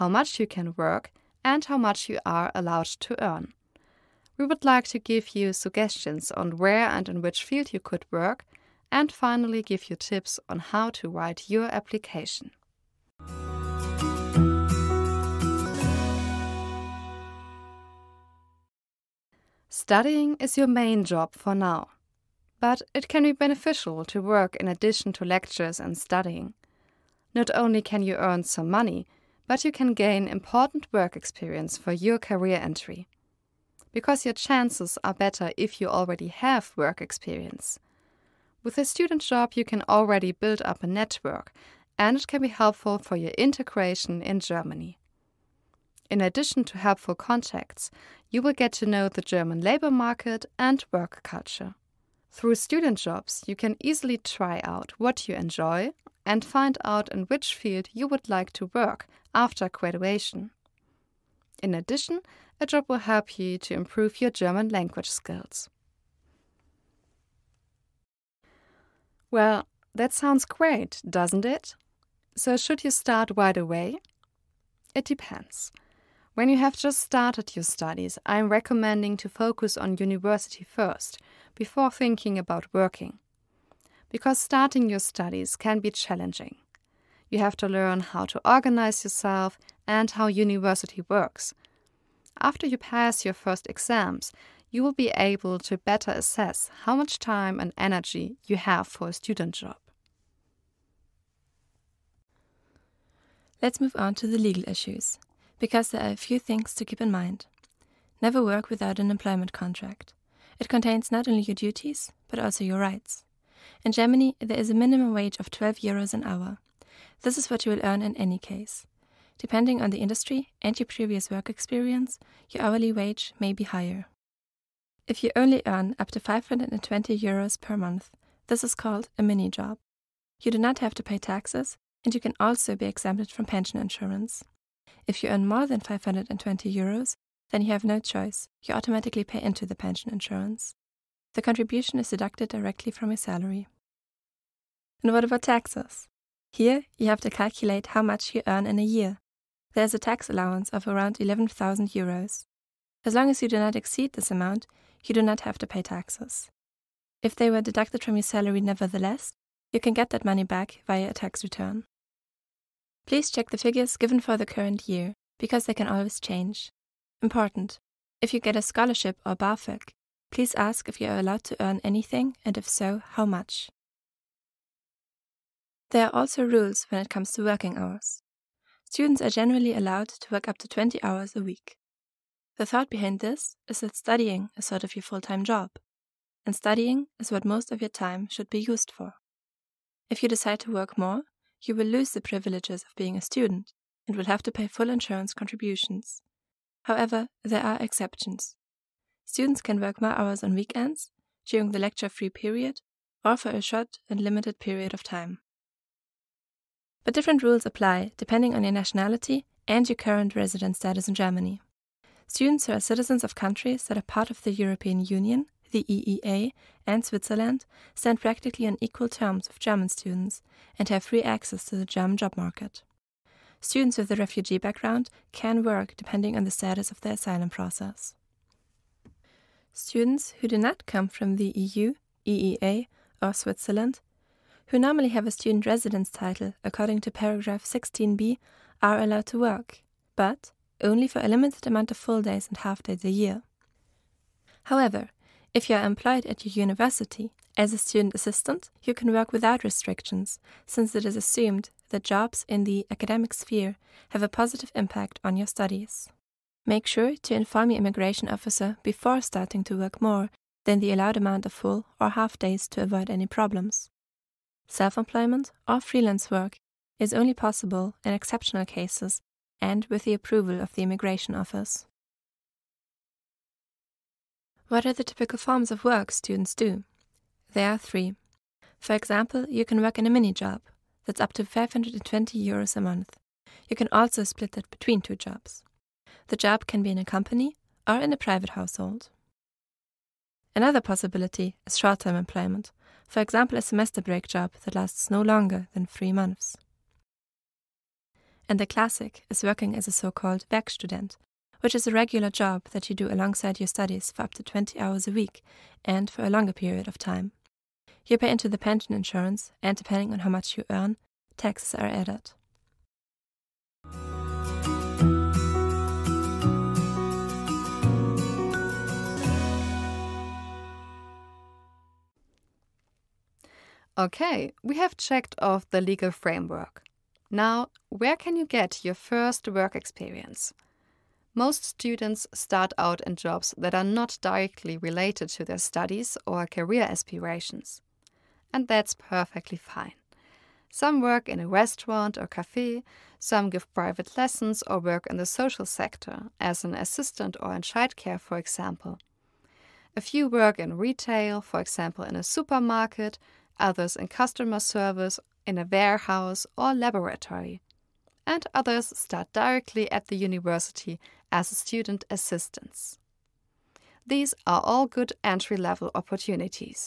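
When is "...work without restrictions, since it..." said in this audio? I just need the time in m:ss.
4:09.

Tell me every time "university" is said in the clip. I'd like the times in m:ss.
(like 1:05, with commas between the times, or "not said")
1:19, 1:30, 4:06, 6:00.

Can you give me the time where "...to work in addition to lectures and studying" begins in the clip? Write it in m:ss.
0:24.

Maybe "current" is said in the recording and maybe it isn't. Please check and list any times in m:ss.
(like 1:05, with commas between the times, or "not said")
2:44, 3:29.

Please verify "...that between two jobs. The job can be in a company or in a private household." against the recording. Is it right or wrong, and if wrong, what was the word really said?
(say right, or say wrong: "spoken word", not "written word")
right.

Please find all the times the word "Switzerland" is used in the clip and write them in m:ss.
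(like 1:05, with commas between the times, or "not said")
3:37, 3:53.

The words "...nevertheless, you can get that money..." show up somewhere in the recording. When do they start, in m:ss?
2:38.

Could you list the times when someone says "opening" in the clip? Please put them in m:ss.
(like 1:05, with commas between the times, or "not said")
not said.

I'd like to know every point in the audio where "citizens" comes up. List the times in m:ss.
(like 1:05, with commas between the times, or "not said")
3:32.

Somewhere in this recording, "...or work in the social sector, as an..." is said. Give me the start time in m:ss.
5:44.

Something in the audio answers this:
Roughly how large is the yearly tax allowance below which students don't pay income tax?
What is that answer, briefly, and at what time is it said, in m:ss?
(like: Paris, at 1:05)
11,000 euros, at 2:31.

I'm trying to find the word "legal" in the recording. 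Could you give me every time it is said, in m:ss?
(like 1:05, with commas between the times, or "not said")
1:44, 5:25.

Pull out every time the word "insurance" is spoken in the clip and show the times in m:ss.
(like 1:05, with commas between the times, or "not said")
2:13, 2:20, 3:14, 5:08.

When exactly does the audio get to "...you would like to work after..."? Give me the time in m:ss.
0:57.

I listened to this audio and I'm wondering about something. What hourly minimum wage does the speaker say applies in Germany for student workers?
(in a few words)
12 euros.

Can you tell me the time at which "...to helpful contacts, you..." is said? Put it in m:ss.
0:46.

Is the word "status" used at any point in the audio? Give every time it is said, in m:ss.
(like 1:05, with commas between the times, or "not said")
3:30, 3:46.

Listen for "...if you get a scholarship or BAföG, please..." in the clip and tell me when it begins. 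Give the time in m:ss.
2:48.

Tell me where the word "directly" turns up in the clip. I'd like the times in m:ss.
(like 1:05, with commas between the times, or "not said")
2:22, 5:34, 5:59.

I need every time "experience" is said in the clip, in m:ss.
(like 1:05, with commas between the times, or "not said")
0:31, 0:36, 2:01, 5:29.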